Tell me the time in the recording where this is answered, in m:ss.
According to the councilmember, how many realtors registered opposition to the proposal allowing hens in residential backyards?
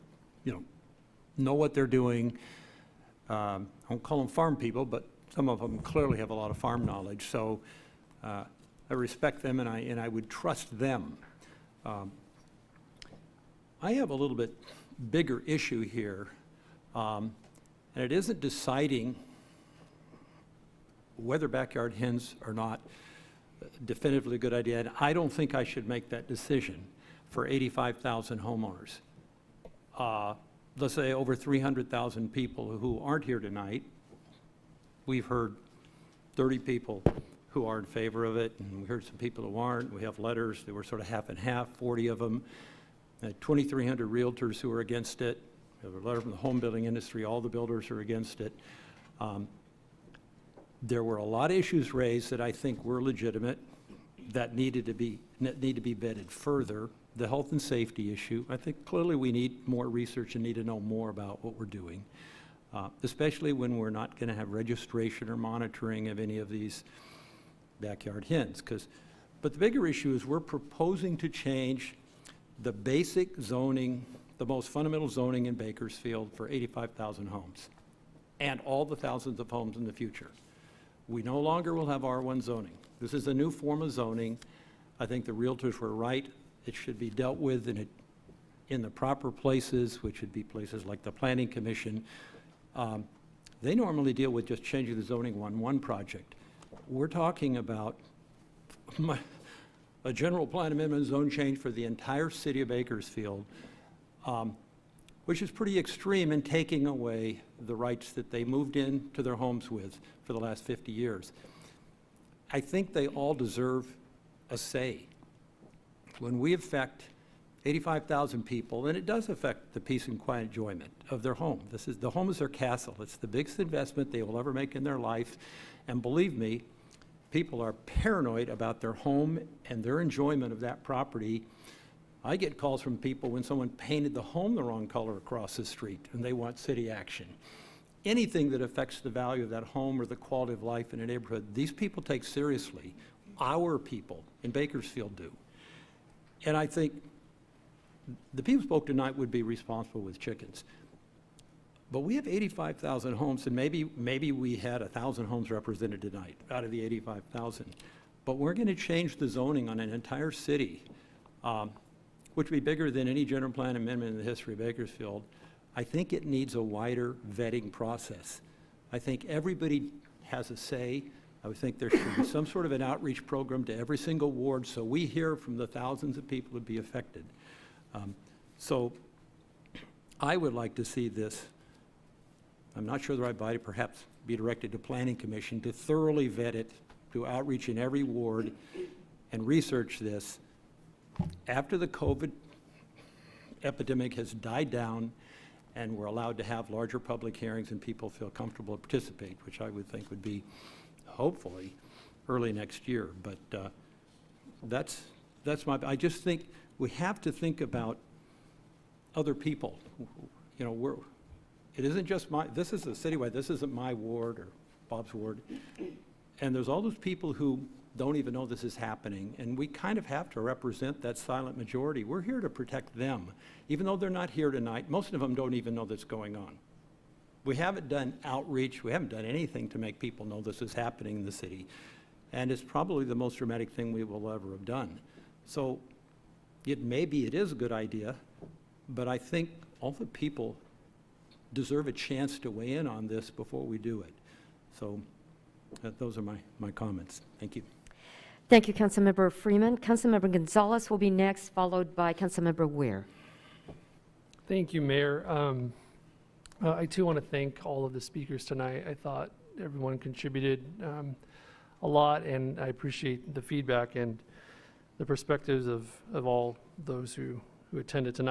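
0:43.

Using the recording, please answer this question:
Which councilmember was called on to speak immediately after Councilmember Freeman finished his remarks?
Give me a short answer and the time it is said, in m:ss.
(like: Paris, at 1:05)
Gonzales, at 4:10.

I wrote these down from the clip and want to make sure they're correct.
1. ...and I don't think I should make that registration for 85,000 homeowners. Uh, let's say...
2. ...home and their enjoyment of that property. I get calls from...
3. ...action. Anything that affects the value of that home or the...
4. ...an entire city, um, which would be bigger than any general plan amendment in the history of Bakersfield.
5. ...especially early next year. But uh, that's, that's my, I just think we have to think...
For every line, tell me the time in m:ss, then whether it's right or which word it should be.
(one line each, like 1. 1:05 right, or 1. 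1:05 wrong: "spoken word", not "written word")
1. 0:24 wrong: "decision", not "registration"
2. 2:08 right
3. 2:16 right
4. 2:39 right
5. 3:21 wrong: "hopefully", not "especially".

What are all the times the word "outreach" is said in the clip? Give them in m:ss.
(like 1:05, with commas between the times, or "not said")
2:52, 3:07, 3:48.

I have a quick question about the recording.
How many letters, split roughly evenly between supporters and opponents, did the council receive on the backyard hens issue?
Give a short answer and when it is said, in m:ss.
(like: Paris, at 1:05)
40, at 0:41.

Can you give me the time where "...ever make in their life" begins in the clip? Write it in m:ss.
2:04.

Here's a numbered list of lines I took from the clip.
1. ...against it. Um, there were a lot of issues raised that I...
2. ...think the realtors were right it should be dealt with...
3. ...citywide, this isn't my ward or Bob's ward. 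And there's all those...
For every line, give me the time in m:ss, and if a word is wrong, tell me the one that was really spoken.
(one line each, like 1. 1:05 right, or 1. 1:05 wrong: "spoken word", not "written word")
1. 0:48 right
2. 1:25 right
3. 3:32 right.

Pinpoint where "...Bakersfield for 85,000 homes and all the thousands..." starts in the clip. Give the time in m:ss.
1:15.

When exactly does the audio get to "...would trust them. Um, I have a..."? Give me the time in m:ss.
0:10.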